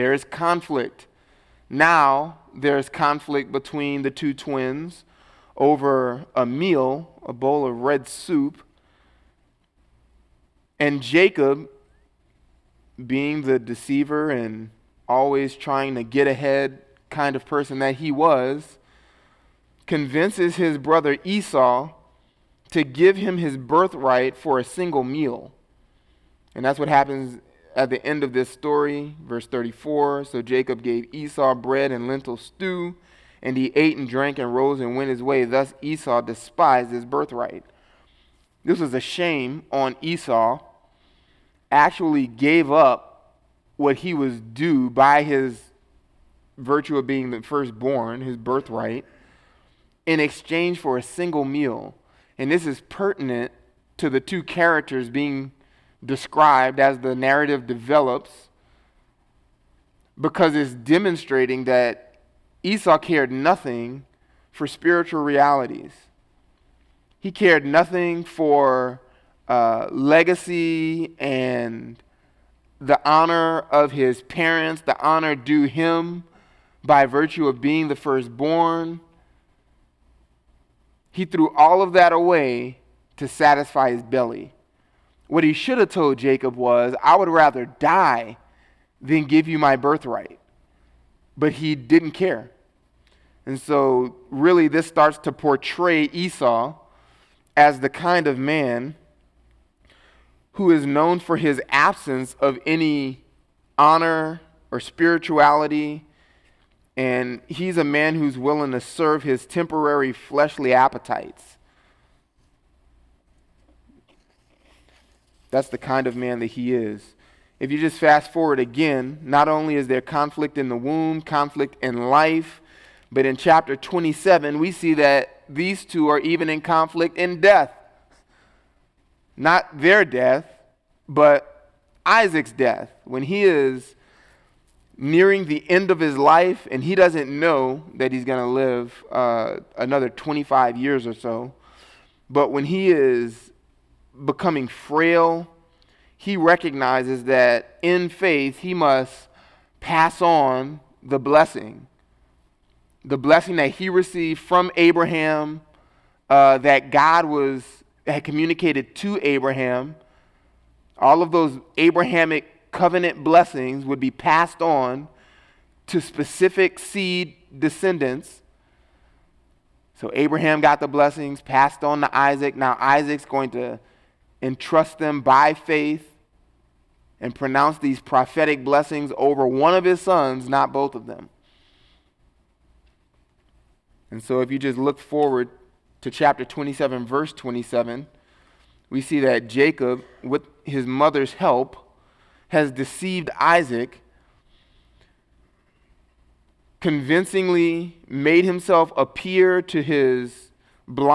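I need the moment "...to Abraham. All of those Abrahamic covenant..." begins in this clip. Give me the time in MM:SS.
02:38.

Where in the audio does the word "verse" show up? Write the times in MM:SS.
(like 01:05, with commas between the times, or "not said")
00:29, 03:07.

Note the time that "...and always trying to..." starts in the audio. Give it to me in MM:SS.
00:14.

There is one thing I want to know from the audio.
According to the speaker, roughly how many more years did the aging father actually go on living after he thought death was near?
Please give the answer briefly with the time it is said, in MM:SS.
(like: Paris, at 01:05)
25, at 02:20.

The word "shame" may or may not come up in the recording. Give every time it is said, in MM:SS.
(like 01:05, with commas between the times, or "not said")
00:38.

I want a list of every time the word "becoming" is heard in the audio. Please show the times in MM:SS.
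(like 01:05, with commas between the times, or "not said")
02:24.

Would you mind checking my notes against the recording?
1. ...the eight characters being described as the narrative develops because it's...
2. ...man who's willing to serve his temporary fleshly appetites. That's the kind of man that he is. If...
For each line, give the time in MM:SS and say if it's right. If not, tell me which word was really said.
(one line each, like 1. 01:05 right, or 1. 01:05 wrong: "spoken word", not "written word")
1. 00:54 wrong: "two", not "eight"
2. 01:47 right.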